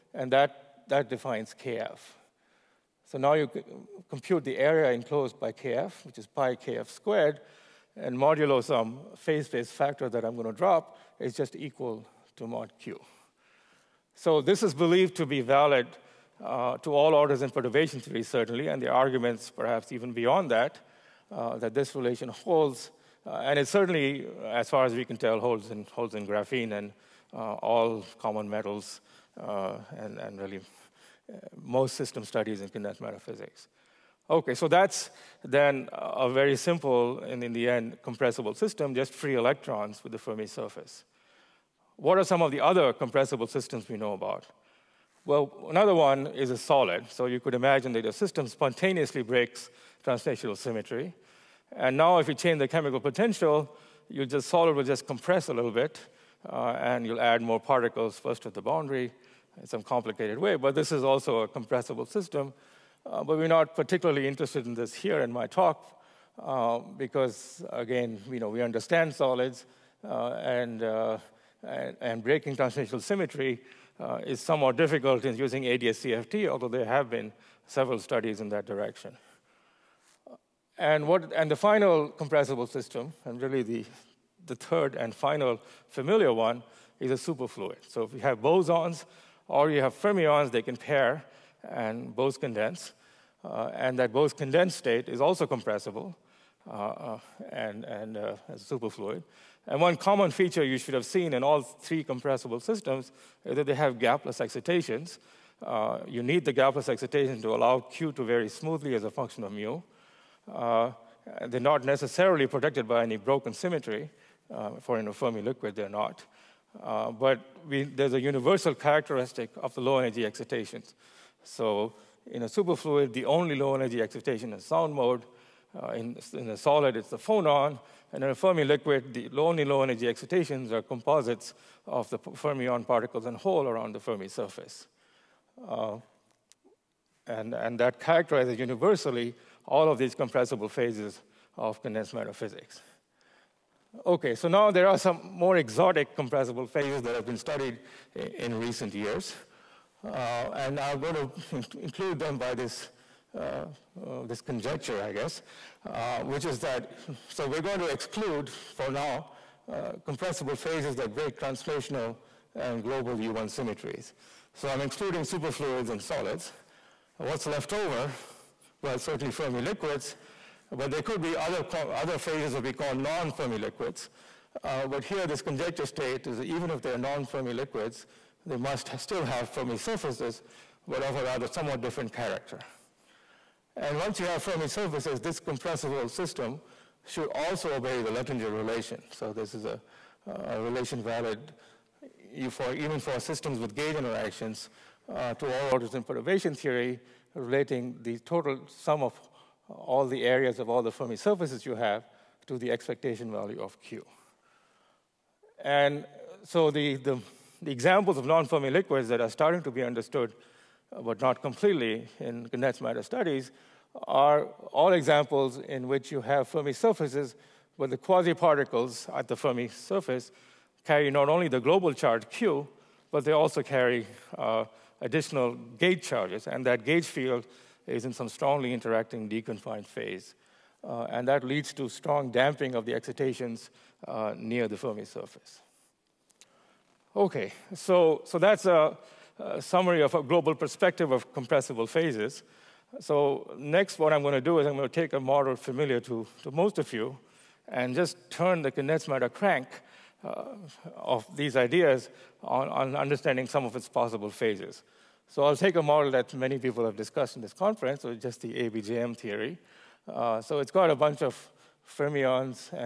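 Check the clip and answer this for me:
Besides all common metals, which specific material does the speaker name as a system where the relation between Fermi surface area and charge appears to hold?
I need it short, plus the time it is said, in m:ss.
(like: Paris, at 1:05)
Graphene, at 0:26.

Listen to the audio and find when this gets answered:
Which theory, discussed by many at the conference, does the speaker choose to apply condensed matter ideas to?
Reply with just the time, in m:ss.
4:18.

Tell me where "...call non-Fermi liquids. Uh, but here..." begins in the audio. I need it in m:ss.
2:52.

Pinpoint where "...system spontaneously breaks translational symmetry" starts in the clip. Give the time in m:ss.
0:48.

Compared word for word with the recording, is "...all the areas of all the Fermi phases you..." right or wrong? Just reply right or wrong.
wrong.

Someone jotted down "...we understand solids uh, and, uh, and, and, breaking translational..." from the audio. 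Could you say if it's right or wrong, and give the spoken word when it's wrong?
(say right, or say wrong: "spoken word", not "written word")
right.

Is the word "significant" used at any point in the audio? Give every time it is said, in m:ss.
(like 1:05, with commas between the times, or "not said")
not said.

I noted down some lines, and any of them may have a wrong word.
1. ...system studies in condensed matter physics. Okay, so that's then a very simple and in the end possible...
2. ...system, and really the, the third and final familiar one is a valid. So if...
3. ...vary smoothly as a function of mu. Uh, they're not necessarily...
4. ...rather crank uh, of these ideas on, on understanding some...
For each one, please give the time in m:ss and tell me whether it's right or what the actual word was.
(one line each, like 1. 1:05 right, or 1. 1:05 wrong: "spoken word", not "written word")
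1. 0:31 wrong: "compressible", not "possible"
2. 1:22 wrong: "superfluid", not "valid"
3. 1:48 right
4. 4:09 wrong: "matter", not "rather".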